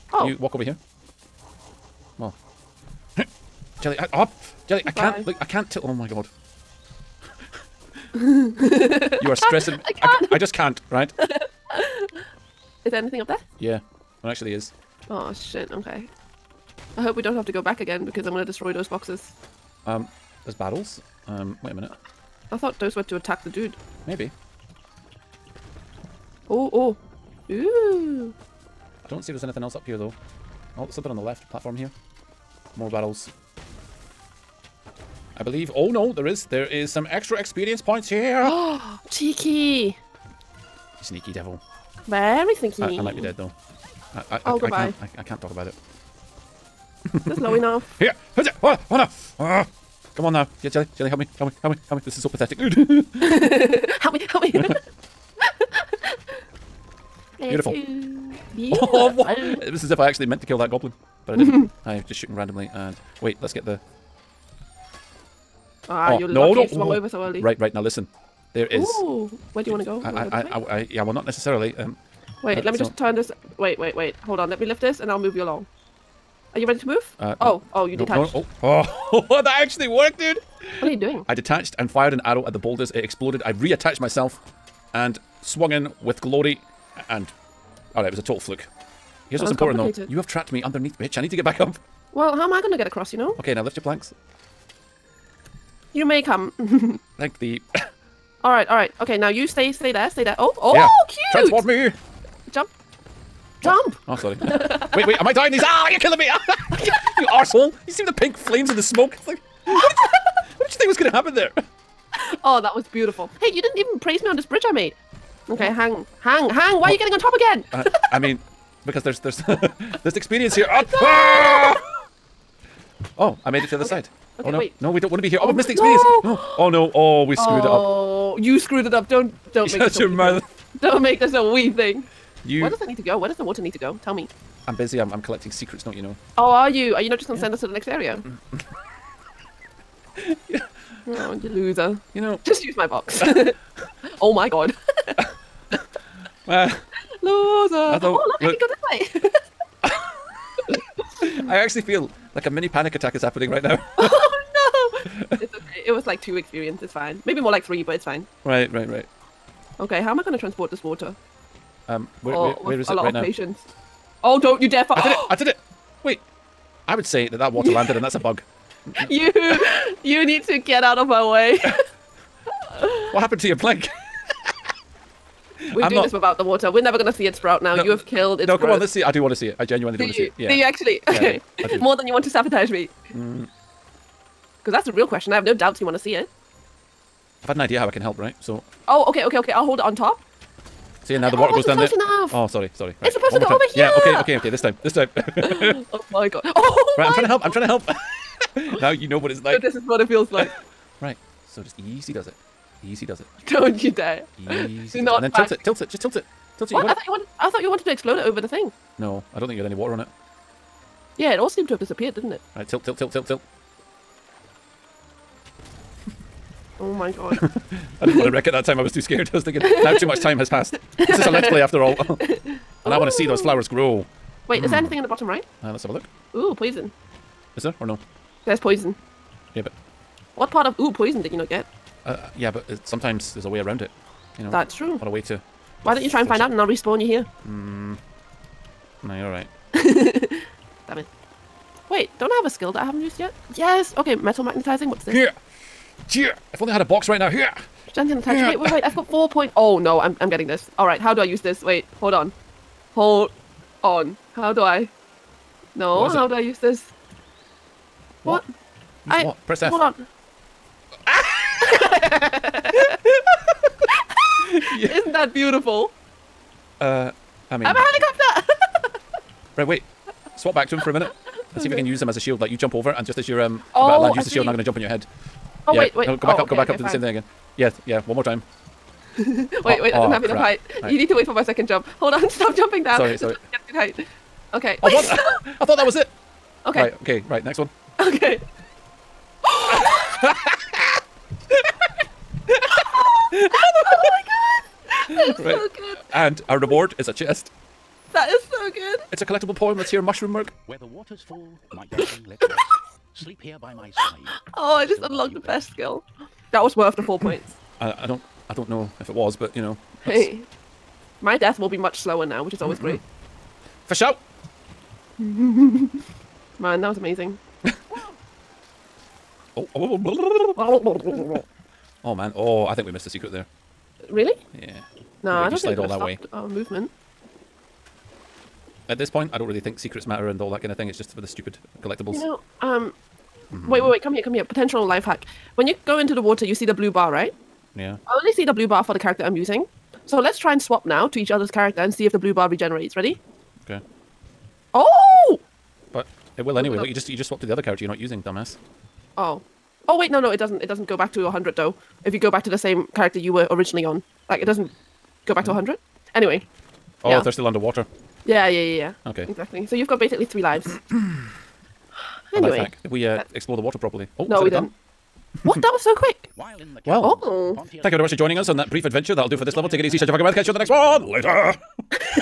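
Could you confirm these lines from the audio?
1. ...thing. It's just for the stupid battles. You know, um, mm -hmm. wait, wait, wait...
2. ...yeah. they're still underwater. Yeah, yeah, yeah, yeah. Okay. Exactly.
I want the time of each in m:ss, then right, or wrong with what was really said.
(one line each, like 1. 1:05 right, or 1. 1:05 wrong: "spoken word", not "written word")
1. 5:30 wrong: "collectibles", not "battles"
2. 5:57 right.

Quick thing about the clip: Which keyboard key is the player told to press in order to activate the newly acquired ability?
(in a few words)
F.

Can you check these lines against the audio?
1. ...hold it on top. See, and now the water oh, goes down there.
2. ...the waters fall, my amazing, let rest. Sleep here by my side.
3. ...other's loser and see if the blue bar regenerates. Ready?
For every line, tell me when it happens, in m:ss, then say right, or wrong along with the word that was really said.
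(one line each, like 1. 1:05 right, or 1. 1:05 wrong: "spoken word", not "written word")
1. 3:09 right
2. 5:00 wrong: "darling", not "amazing"
3. 5:41 wrong: "character", not "loser".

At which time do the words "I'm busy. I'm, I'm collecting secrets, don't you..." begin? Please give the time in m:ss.
2:14.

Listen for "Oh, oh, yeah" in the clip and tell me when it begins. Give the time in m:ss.
1:40.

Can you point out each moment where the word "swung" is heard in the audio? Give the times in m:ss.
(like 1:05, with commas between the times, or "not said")
1:06, 1:25.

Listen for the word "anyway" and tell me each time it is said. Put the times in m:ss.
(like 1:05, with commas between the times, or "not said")
5:46, 5:56, 6:02.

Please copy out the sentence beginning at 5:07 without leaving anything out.
I, I don't, I don't know if it was, but you know.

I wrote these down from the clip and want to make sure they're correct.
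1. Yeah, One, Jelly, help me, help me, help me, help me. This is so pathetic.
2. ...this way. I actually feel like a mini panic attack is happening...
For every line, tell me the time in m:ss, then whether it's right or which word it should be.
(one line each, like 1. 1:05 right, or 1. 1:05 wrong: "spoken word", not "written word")
1. 0:50 wrong: "Jelly", not "One"
2. 2:30 right.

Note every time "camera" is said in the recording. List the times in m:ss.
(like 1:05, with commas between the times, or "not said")
not said.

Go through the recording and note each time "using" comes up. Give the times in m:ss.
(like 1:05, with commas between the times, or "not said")
5:39, 5:47.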